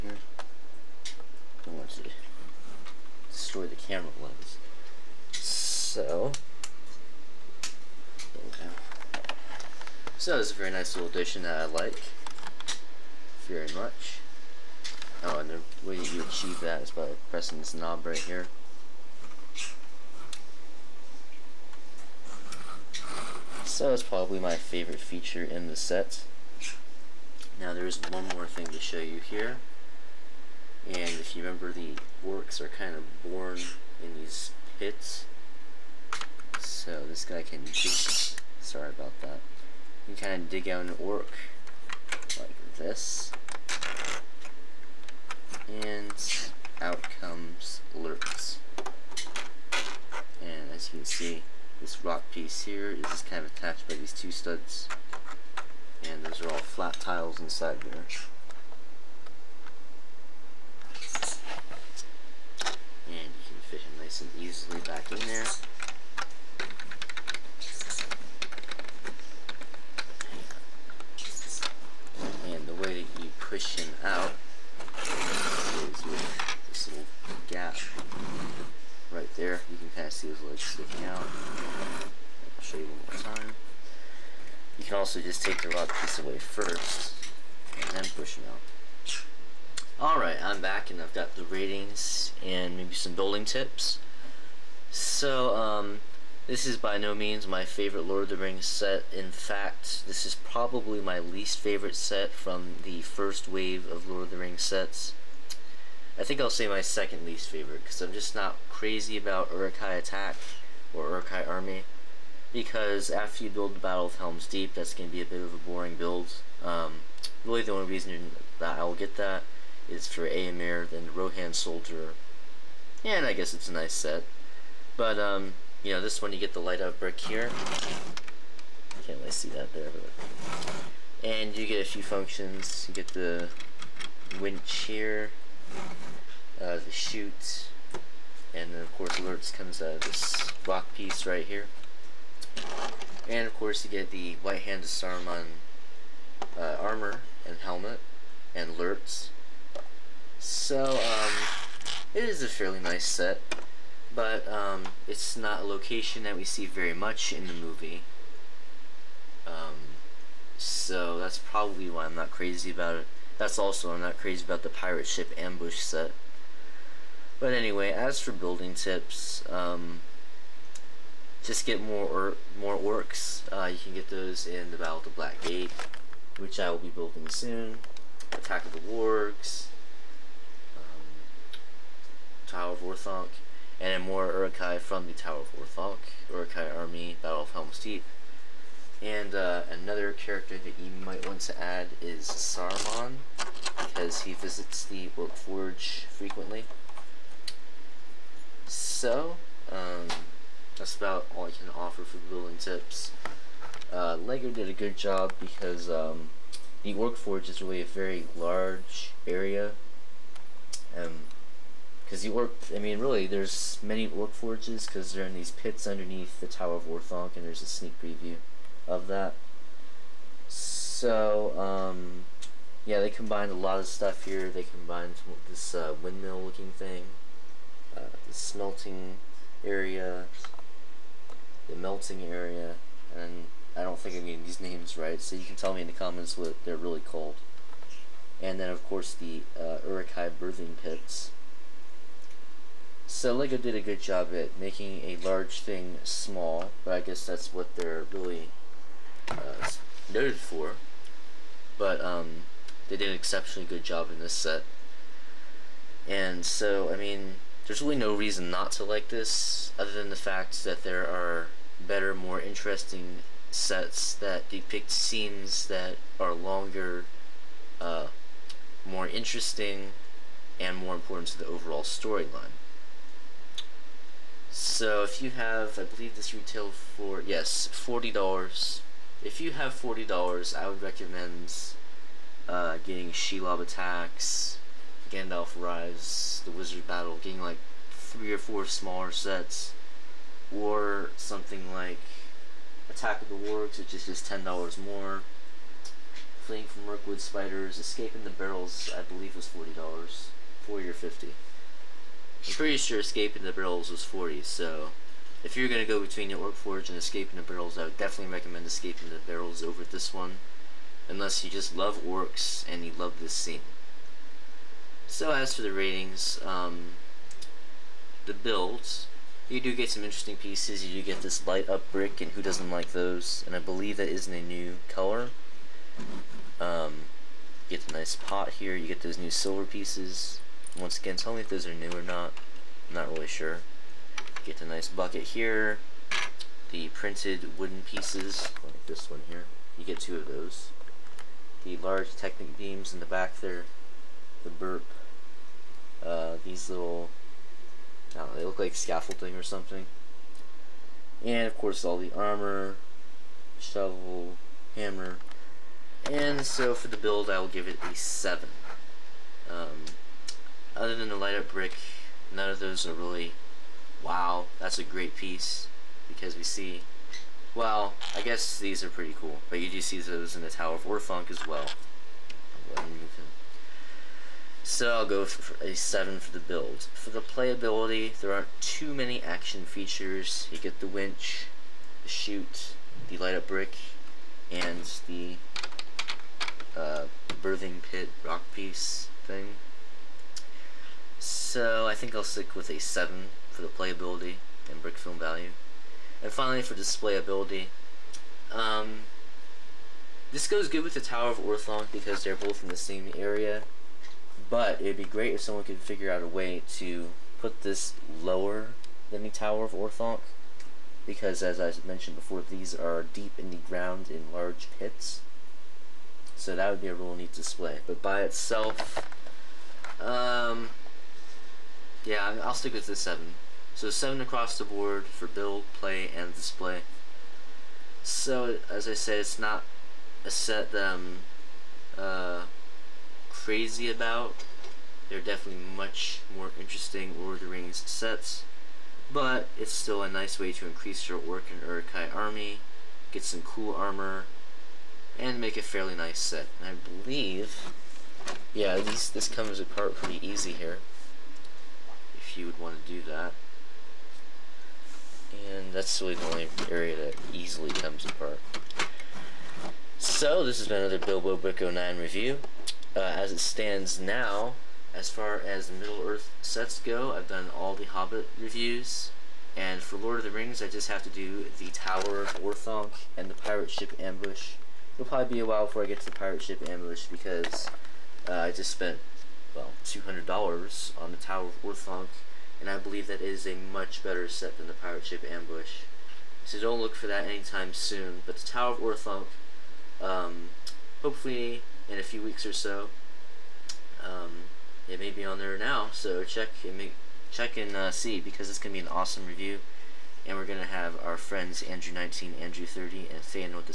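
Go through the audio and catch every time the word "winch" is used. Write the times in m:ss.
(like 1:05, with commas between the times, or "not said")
2:14, 6:20.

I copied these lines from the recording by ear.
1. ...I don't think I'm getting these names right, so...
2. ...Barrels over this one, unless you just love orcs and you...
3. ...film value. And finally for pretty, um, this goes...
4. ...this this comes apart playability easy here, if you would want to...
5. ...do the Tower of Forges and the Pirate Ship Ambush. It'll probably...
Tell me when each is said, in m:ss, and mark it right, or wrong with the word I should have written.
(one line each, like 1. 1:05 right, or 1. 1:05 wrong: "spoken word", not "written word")
1. 3:53 right
2. 5:09 right
3. 6:34 wrong: "displayability", not "pretty"
4. 7:28 wrong: "pretty", not "playability"
5. 7:51 wrong: "Orthanc", not "Forges".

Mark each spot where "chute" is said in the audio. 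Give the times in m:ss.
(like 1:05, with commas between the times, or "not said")
2:16, 6:22.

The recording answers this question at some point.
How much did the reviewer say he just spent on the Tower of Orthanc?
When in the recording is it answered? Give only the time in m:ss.
7:59.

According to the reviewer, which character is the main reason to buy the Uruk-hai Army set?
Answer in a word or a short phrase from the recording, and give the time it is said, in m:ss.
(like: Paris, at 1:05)
Éomer, at 2:00.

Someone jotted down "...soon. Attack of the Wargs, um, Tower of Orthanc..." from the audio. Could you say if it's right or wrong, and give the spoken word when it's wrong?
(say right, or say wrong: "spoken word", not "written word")
right.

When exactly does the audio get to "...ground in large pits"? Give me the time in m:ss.
6:53.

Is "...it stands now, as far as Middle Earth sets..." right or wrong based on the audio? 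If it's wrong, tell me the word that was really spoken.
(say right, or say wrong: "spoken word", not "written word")
right.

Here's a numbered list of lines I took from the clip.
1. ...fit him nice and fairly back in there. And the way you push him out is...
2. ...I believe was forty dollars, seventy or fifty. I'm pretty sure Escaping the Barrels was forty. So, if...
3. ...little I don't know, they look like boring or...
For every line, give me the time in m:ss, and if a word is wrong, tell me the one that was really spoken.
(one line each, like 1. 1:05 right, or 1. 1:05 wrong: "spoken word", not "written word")
1. 1:03 wrong: "easily", not "fairly"
2. 4:58 wrong: "forty", not "seventy"
3. 5:46 wrong: "scaffolding", not "boring".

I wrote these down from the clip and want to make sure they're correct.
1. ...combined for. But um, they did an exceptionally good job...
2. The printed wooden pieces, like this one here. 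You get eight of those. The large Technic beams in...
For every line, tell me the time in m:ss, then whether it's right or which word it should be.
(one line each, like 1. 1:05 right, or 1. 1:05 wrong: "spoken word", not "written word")
1. 4:10 wrong: "noted", not "combined"
2. 5:36 wrong: "two", not "eight".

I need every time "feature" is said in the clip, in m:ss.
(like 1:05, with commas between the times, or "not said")
0:25, 6:19.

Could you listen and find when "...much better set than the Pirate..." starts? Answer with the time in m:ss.
8:03.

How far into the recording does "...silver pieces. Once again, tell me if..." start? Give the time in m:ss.
5:29.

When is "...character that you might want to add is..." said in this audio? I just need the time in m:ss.
3:10.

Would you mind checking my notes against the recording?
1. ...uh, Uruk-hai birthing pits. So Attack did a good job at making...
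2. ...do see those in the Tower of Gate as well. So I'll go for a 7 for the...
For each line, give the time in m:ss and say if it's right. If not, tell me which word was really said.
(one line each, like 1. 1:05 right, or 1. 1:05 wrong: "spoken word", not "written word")
1. 3:59 wrong: "LEGO", not "Attack"
2. 6:09 wrong: "Orthanc", not "Gate".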